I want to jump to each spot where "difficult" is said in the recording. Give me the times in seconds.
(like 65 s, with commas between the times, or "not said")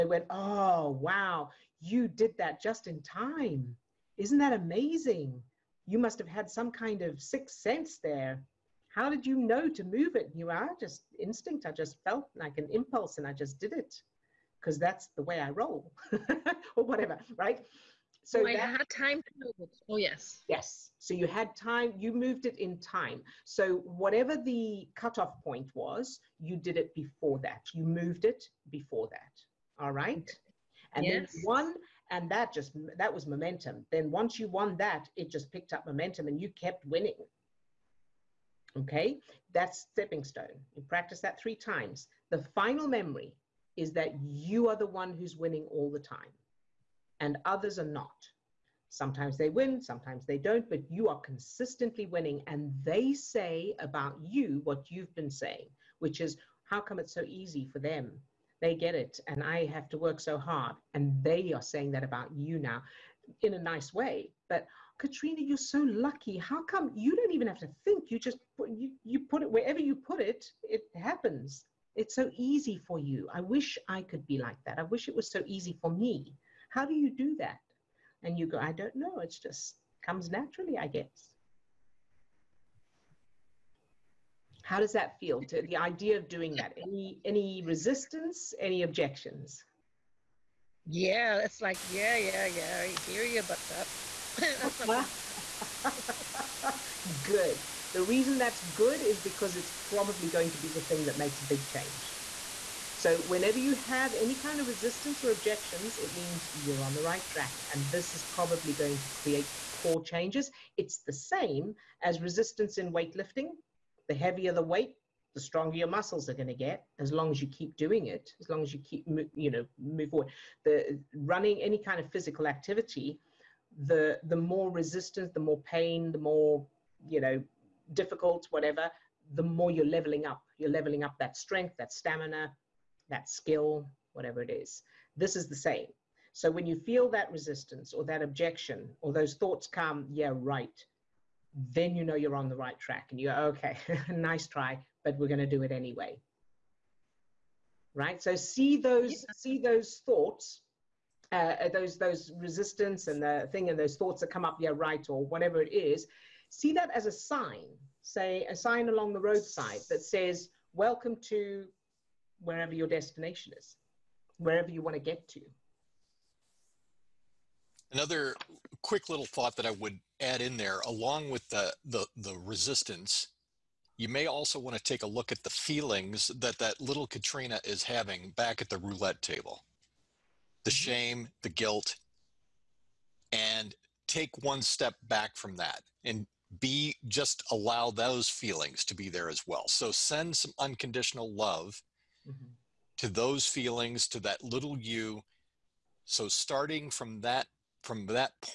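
127 s.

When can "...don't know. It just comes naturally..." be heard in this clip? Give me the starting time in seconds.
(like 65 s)
78 s.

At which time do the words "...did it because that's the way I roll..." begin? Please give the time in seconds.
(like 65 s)
13 s.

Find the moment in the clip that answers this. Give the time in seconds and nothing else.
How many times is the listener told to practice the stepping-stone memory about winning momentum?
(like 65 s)
41 s.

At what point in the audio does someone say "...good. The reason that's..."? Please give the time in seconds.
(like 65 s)
97 s.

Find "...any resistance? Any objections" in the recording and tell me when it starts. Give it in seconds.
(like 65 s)
87 s.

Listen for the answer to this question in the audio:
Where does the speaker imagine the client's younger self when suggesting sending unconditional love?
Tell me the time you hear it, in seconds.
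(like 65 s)
178 s.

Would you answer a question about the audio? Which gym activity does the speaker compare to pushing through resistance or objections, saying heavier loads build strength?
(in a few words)
weightlifting.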